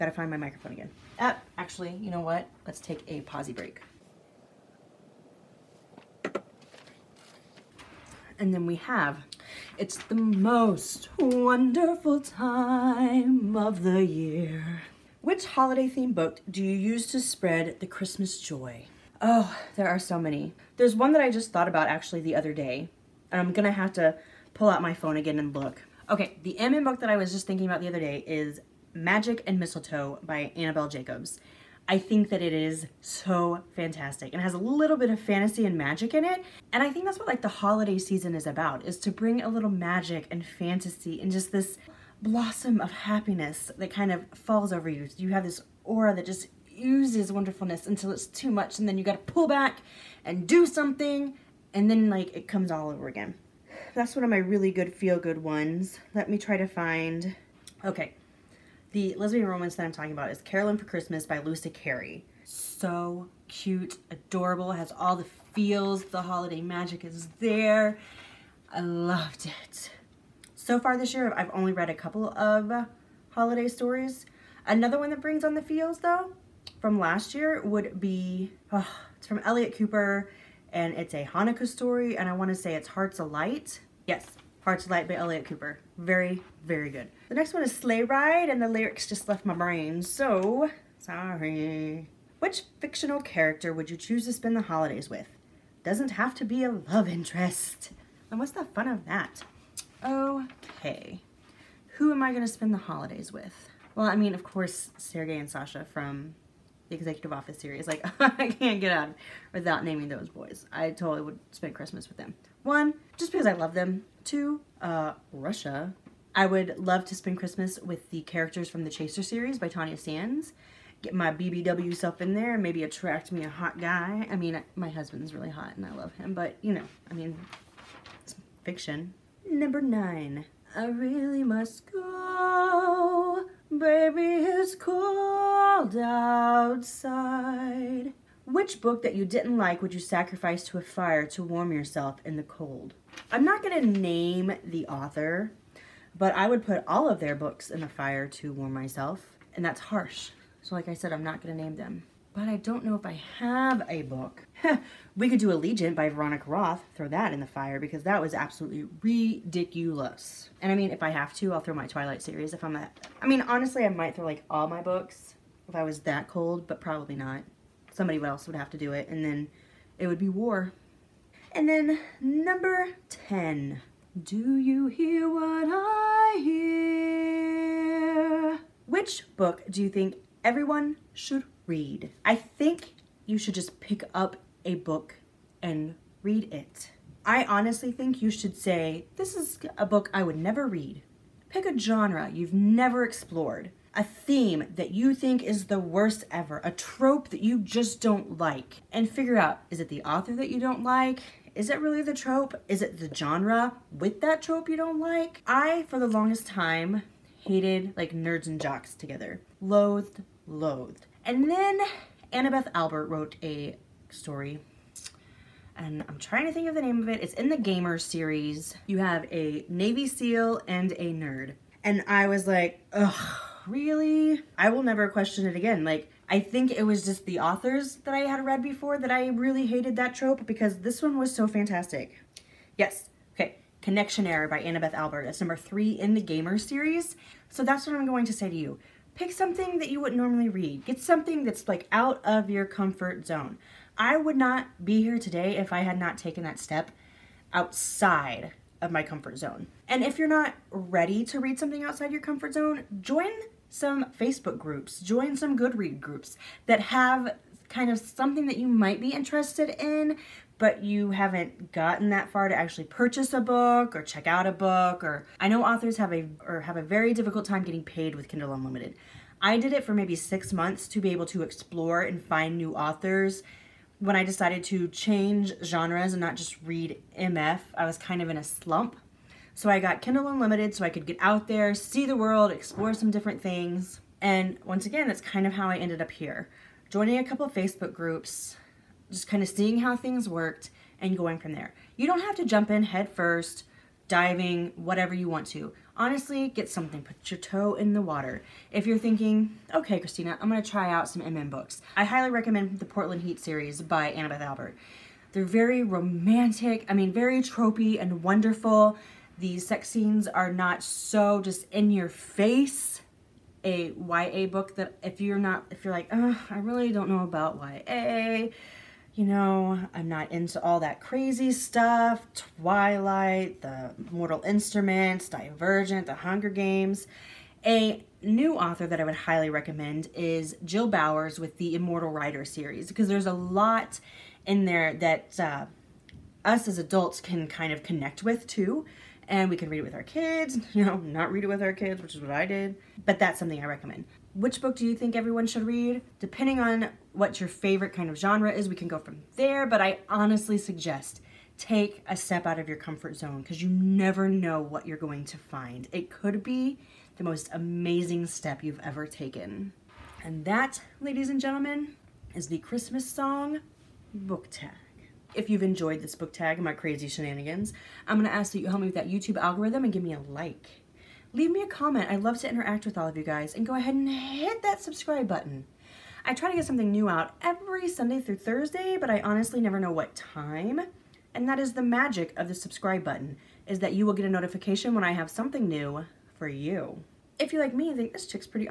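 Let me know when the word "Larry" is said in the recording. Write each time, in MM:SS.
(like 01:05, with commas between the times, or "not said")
not said.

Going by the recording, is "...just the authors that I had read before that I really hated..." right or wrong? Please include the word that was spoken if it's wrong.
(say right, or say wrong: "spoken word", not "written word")
right.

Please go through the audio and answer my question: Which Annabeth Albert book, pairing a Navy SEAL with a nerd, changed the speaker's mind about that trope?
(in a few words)
Connection Error.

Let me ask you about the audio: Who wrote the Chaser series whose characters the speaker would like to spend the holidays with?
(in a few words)
Tanya Sands.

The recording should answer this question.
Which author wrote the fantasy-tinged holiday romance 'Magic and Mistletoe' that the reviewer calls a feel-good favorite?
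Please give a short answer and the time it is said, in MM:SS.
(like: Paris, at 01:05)
Annabelle Jacobs, at 00:30.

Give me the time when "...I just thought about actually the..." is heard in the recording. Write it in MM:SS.
00:21.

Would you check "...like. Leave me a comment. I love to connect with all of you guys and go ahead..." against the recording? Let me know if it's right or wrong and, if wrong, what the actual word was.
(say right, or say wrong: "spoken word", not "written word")
wrong: "interact", not "connect".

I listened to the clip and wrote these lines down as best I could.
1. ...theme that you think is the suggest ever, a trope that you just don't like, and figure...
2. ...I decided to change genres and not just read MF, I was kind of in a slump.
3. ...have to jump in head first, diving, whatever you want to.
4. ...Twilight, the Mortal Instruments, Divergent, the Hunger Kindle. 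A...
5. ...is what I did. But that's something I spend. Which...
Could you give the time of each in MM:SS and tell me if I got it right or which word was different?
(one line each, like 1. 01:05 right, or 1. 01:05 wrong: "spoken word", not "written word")
1. 03:14 wrong: "worst", not "suggest"
2. 04:34 right
3. 04:52 right
4. 05:22 wrong: "Games", not "Kindle"
5. 05:42 wrong: "recommend", not "spend".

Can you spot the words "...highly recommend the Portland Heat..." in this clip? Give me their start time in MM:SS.
05:02.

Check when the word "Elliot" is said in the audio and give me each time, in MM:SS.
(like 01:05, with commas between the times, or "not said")
01:19, 01:25.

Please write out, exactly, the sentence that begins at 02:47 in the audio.
Somebody else would have to do it and then it would be war.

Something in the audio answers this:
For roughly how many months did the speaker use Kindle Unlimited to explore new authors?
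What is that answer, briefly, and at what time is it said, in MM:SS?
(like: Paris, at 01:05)
6 months, at 04:30.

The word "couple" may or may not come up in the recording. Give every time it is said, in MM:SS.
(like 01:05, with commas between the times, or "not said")
01:11, 04:47.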